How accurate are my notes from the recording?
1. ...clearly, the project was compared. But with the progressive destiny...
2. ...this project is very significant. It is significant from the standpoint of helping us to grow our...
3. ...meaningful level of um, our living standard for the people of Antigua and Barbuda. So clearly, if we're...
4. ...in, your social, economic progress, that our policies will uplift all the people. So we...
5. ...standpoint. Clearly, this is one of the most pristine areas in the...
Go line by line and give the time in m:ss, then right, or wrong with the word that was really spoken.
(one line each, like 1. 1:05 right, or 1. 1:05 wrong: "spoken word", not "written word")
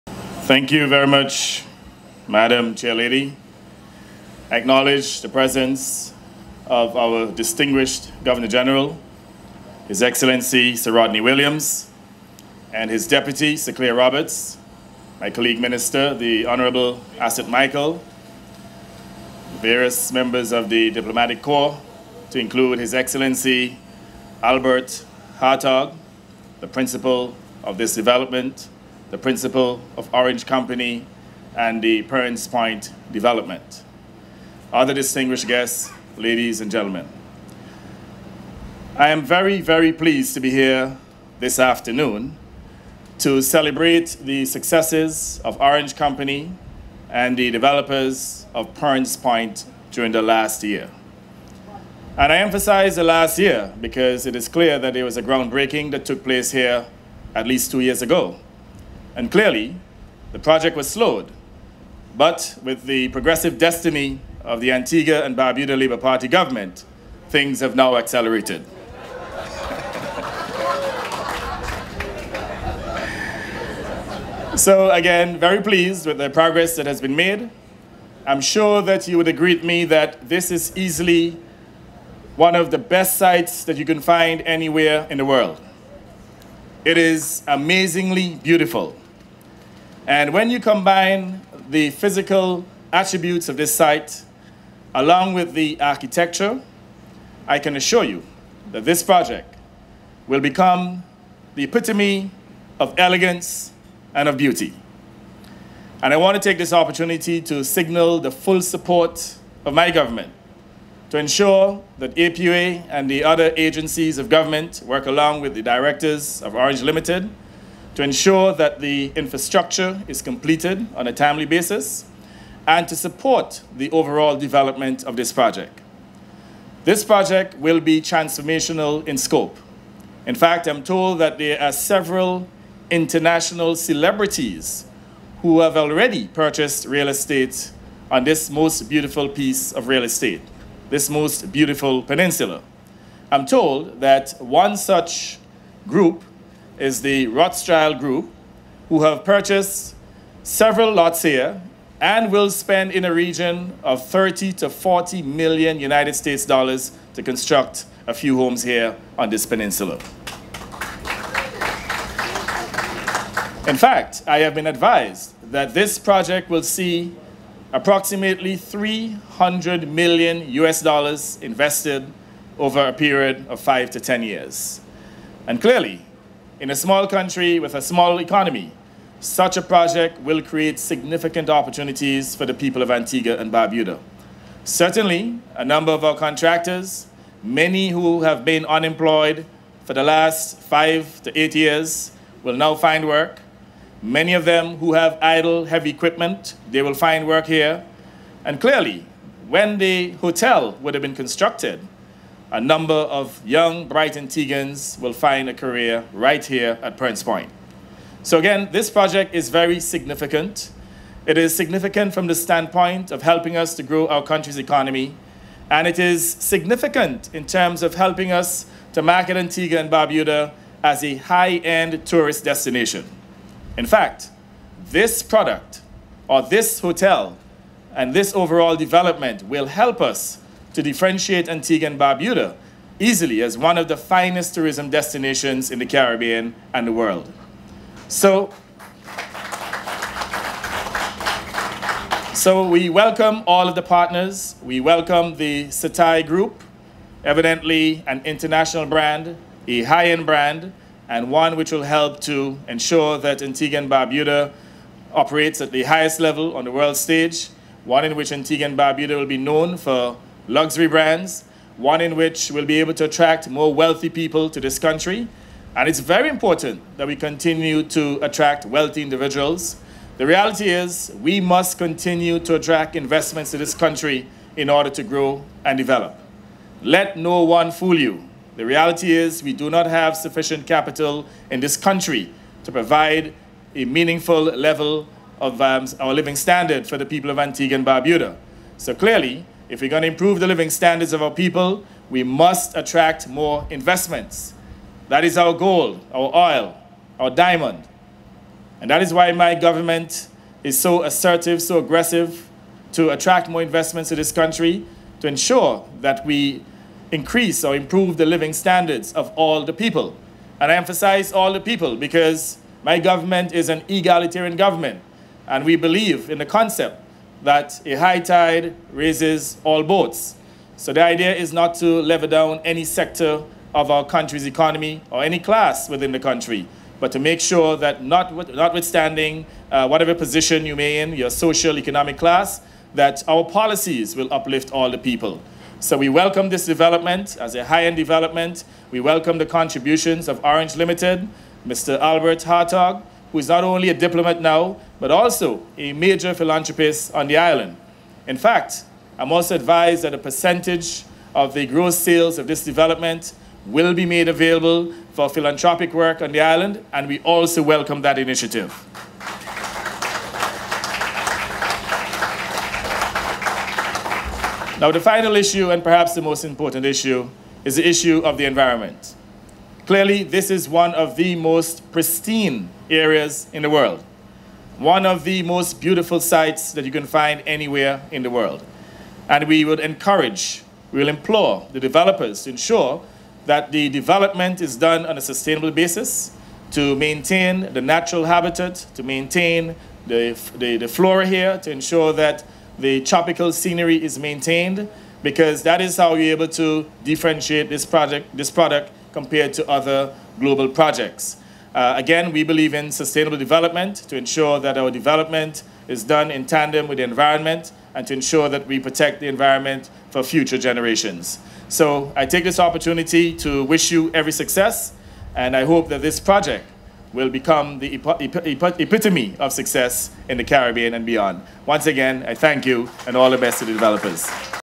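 1. 0:59 wrong: "slowed", not "compared"
2. 3:28 right
3. 4:43 right
4. 5:30 wrong: "class", not "progress"
5. 6:08 wrong: "environment", not "standpoint".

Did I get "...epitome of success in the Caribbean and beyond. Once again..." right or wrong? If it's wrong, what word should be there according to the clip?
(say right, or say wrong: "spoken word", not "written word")
right.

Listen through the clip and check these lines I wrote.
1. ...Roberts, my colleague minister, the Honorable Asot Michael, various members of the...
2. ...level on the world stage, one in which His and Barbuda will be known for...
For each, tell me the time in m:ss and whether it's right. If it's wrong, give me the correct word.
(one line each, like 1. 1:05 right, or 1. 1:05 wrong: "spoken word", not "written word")
1. 0:13 right
2. 4:16 wrong: "Antigua", not "His".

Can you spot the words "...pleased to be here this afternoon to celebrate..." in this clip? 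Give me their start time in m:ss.
0:39.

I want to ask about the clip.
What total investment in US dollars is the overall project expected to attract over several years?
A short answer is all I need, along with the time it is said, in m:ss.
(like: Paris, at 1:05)
300 million, at 2:48.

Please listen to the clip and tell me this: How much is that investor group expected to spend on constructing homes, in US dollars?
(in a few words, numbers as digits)
30 to 40 million.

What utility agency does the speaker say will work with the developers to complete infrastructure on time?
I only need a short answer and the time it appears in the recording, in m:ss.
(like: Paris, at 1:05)
APUA, at 1:52.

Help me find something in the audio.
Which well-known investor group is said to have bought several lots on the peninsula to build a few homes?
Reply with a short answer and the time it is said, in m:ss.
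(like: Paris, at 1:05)
Rothschild Group, at 2:27.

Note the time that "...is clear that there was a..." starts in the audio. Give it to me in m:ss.
0:54.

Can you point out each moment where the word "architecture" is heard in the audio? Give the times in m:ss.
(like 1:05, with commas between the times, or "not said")
1:35.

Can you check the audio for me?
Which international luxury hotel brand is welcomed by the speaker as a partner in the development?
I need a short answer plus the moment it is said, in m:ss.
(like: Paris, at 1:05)
Setai Group, at 4:05.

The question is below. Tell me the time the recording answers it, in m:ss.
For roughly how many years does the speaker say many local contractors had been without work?
3:10.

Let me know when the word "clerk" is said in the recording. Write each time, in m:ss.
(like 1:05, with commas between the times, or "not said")
not said.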